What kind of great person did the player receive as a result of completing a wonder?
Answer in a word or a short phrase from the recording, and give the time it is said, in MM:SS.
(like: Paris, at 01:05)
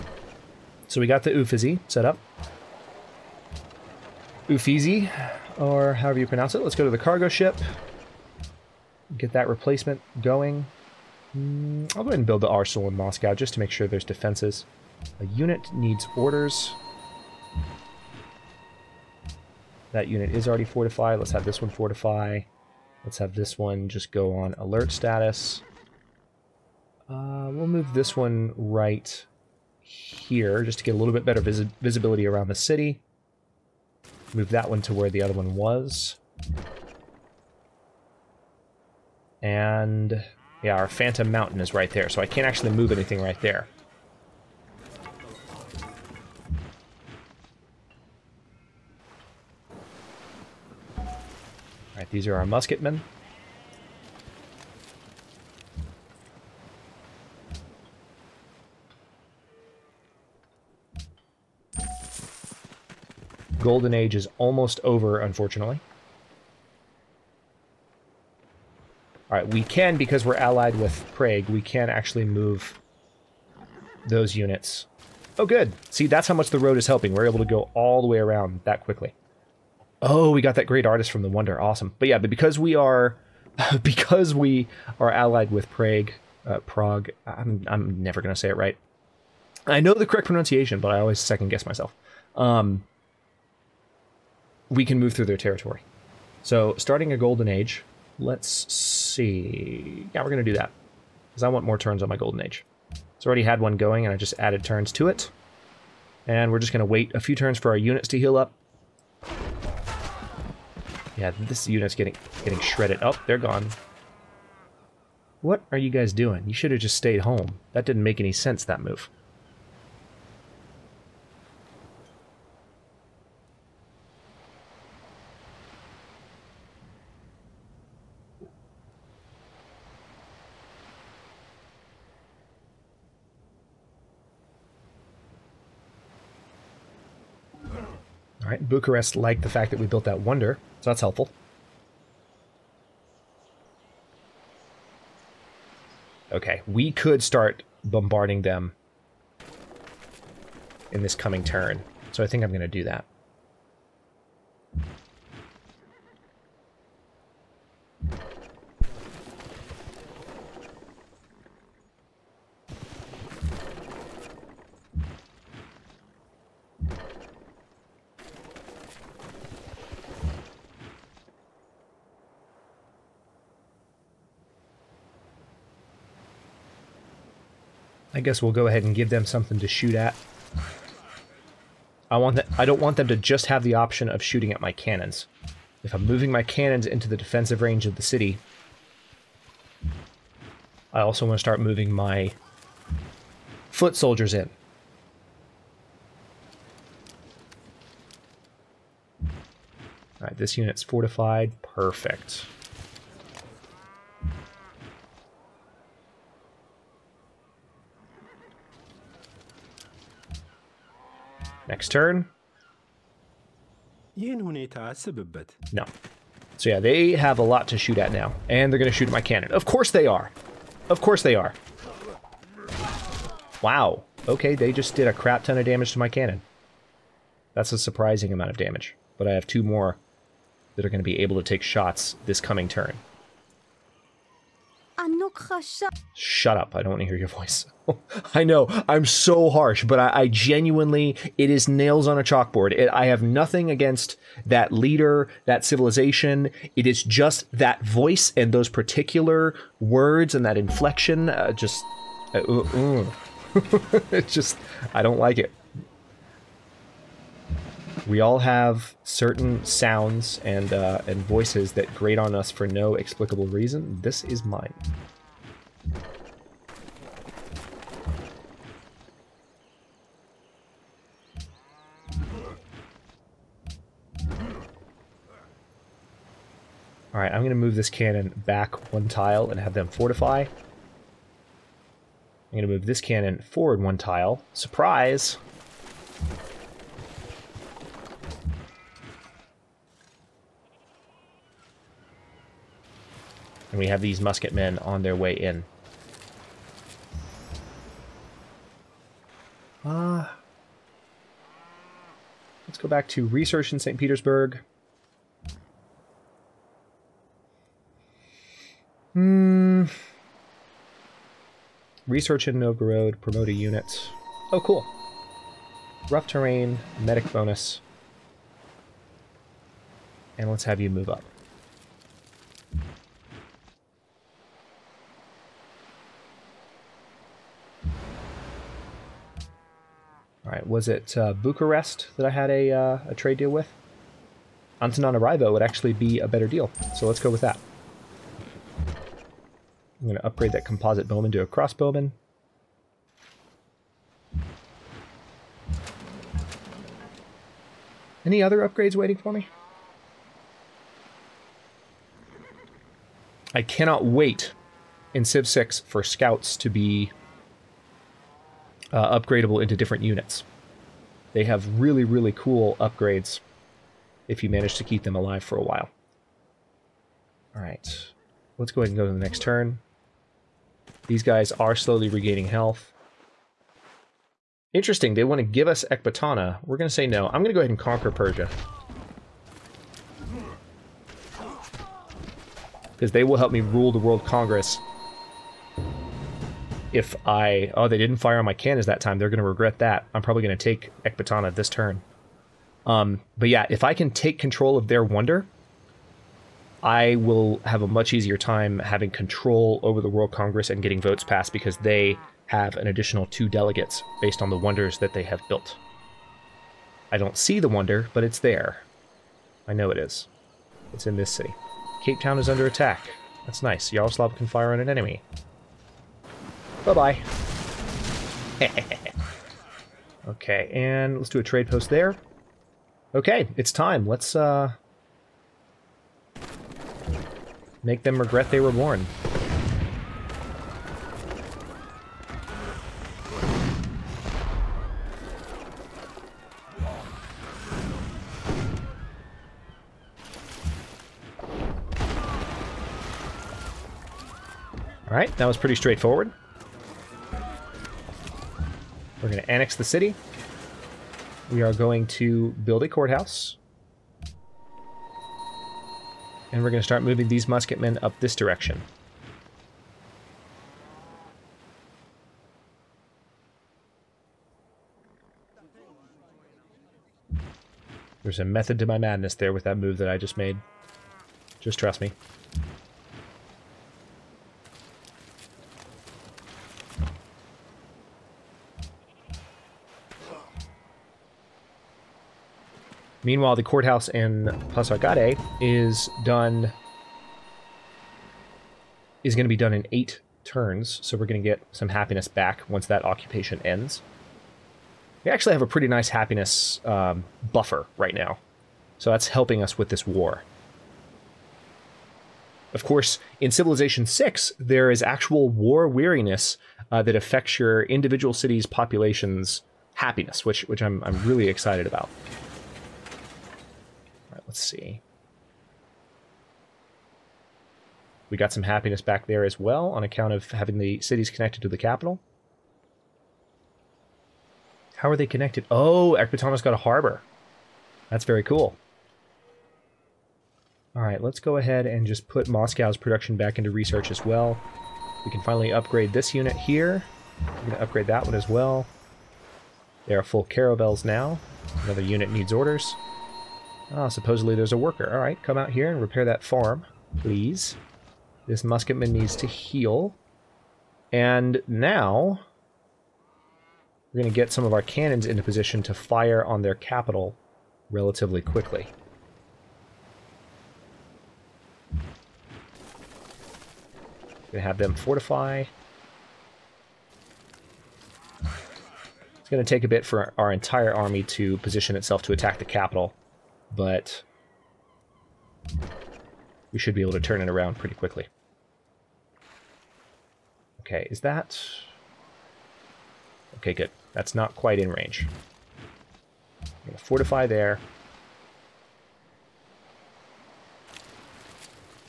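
Great artist, at 01:20.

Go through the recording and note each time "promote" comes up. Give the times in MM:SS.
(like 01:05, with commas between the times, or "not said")
05:13.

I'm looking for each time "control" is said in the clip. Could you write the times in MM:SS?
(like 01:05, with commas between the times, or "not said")
06:34, 06:39.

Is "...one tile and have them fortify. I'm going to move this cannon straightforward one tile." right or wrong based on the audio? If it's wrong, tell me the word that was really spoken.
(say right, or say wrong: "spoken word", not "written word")
wrong: "forward", not "straightforward".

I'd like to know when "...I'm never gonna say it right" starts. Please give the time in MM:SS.
01:27.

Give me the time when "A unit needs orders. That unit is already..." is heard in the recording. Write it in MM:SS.
00:15.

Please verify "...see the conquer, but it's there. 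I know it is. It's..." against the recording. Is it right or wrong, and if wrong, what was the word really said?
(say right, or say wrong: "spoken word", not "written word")
wrong: "wonder", not "conquer".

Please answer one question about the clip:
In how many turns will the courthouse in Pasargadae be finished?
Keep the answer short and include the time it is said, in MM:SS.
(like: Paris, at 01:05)
8, at 08:09.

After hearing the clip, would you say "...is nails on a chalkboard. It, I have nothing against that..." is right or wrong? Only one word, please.
right.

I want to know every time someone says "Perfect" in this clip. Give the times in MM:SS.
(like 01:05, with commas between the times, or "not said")
03:21.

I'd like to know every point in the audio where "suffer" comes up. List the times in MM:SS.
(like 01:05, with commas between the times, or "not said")
not said.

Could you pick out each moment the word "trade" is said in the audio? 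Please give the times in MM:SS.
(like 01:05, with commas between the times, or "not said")
05:33, 07:01.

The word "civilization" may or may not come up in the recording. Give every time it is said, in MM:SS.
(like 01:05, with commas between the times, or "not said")
04:05, 08:23.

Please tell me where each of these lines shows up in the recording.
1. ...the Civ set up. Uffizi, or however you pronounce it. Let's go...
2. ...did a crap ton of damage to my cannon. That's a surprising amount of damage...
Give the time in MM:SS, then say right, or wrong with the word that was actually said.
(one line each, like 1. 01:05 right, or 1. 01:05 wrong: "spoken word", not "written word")
1. 00:01 wrong: "Uffizi", not "Civ"
2. 03:44 right.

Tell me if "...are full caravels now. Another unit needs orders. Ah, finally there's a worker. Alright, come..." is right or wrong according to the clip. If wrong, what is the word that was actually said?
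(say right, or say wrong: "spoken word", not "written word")
wrong: "supposedly", not "finally".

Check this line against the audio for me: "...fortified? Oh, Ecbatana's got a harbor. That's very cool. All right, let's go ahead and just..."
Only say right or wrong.
wrong.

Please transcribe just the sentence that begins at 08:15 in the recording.
We actually have a pretty nice happiness um, buffer right now, so that's helping us with this war.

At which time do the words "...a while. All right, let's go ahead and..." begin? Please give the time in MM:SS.
06:05.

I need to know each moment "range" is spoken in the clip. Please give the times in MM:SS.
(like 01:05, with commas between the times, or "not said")
03:07, 09:44.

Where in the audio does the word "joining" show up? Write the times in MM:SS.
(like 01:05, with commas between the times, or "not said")
not said.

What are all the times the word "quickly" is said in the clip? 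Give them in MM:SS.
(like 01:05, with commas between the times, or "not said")
01:18, 09:18, 09:37.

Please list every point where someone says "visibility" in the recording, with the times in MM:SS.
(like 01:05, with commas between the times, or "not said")
00:31.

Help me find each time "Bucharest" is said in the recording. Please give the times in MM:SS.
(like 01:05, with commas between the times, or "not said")
02:18, 05:31.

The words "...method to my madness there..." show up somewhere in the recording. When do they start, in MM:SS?
07:48.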